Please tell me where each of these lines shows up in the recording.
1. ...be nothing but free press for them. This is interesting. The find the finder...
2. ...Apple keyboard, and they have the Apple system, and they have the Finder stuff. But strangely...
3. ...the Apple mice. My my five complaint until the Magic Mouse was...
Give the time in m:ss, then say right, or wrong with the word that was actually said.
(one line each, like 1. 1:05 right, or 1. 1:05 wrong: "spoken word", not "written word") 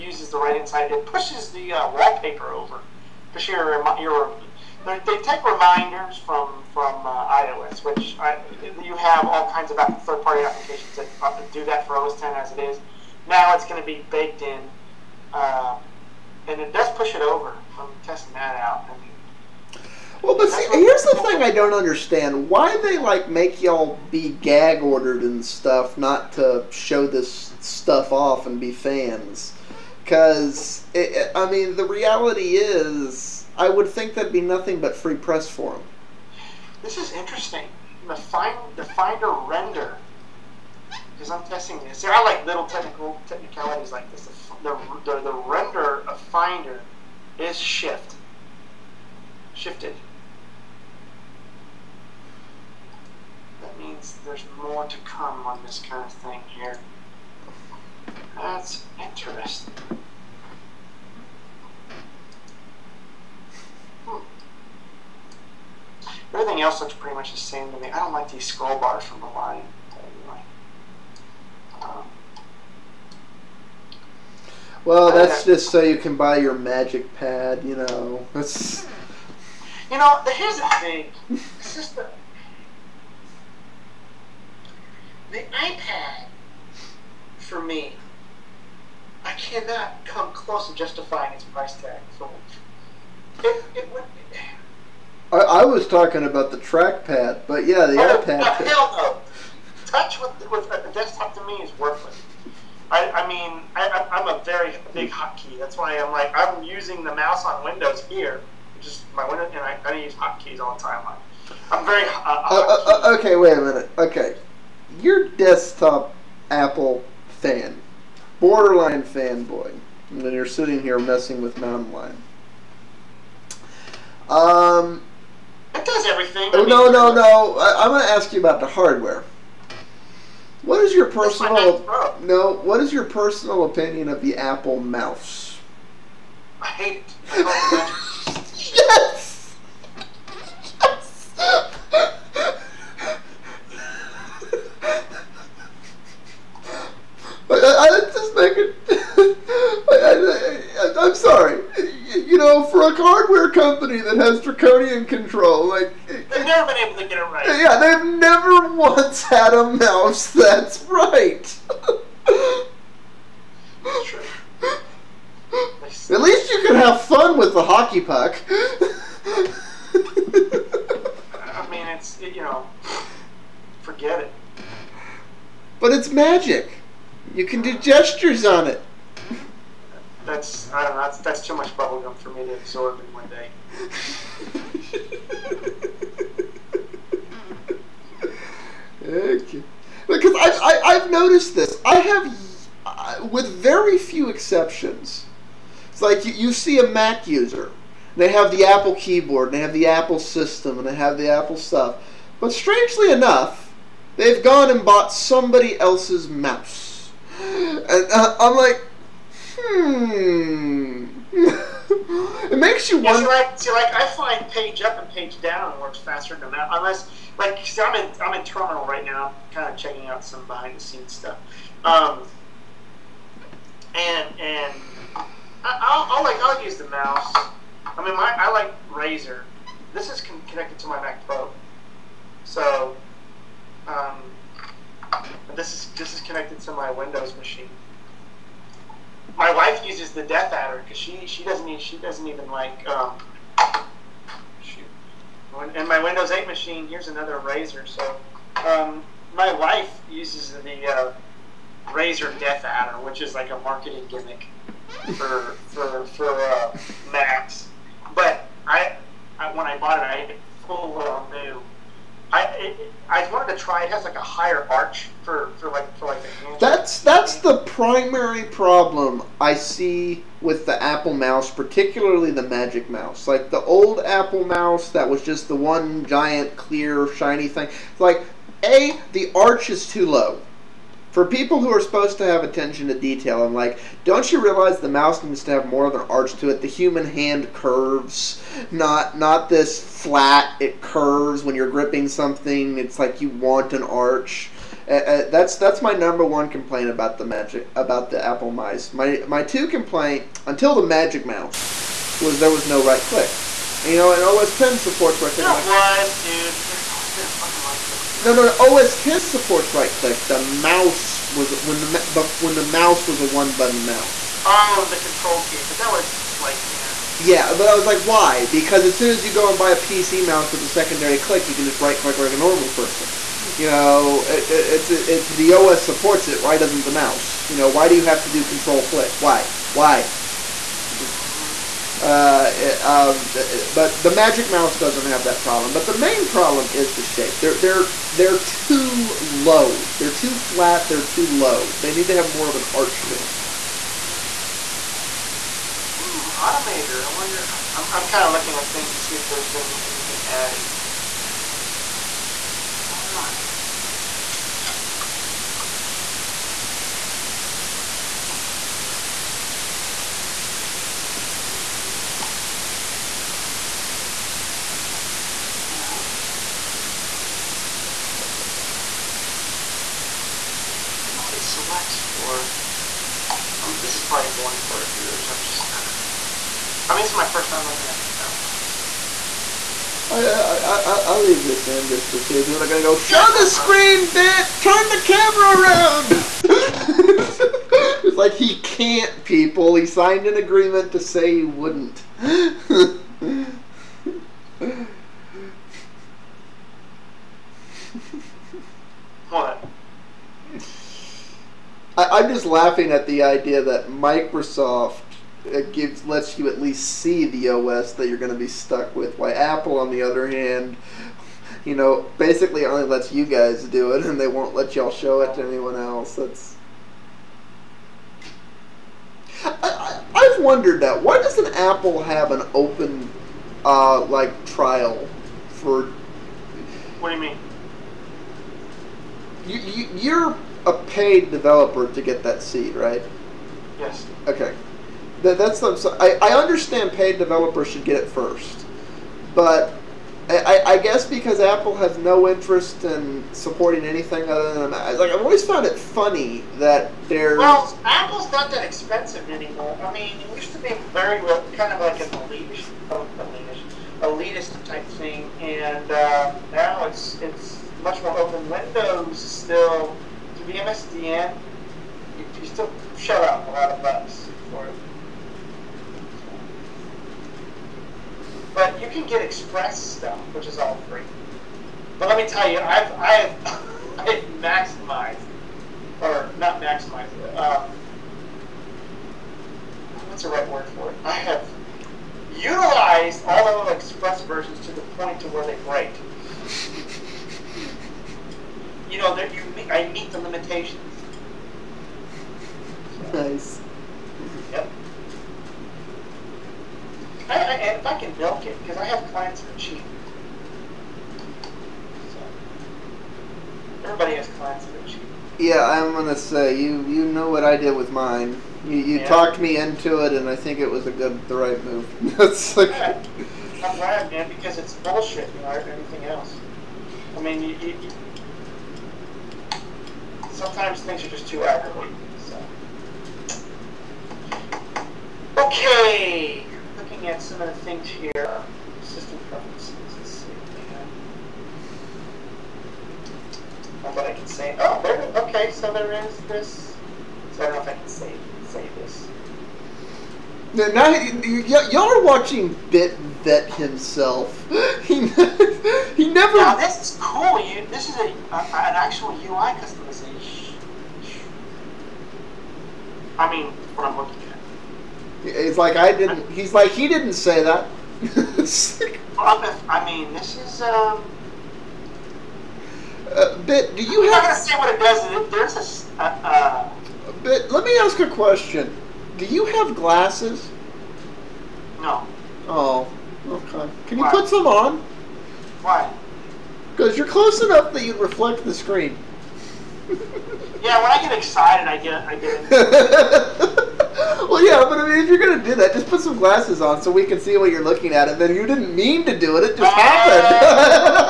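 1. 0:34 right
2. 3:18 wrong: "Apple", not "Finder"
3. 4:58 wrong: "two", not "five".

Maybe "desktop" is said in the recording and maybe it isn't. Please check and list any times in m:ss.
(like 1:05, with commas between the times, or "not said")
1:40, 1:55.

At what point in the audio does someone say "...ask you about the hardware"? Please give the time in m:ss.
2:08.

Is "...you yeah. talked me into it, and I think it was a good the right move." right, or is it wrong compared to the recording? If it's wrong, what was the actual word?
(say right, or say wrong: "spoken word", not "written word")
right.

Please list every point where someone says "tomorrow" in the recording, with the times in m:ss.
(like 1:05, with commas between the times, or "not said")
not said.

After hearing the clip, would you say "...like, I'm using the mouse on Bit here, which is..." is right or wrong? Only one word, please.
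wrong.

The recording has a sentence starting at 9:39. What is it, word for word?
yeah, when I get excited, I get I get.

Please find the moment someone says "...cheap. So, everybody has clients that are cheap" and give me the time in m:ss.
8:19.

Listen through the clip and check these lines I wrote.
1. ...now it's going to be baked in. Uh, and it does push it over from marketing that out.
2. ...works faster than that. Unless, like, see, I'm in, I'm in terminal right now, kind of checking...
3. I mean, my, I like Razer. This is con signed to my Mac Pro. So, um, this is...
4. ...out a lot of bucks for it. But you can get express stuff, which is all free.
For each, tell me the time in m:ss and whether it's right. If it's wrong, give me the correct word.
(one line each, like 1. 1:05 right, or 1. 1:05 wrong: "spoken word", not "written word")
1. 0:13 wrong: "testing", not "marketing"
2. 3:35 right
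3. 3:47 wrong: "connected", not "signed"
4. 7:43 right.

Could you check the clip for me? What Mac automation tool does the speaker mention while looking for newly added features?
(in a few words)
Automator.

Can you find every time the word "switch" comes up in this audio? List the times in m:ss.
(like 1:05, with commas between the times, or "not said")
not said.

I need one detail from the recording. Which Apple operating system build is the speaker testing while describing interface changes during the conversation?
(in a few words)
Mountain Lion.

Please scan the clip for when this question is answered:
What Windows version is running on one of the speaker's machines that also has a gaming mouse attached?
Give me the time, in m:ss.
4:06.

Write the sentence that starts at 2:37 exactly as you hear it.
Yeah, they've never once had a mouse that's right.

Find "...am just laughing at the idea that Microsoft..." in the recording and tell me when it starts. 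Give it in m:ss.
6:42.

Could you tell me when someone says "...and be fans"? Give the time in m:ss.
0:28.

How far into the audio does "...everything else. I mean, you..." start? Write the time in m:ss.
8:35.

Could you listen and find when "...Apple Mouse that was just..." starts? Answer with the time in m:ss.
4:34.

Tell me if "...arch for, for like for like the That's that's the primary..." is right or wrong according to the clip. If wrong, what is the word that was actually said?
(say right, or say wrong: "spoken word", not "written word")
right.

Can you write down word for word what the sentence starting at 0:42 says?
There are like little technical technicalities like this.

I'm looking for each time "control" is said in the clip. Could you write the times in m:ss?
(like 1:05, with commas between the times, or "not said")
2:35, 5:14, 5:28.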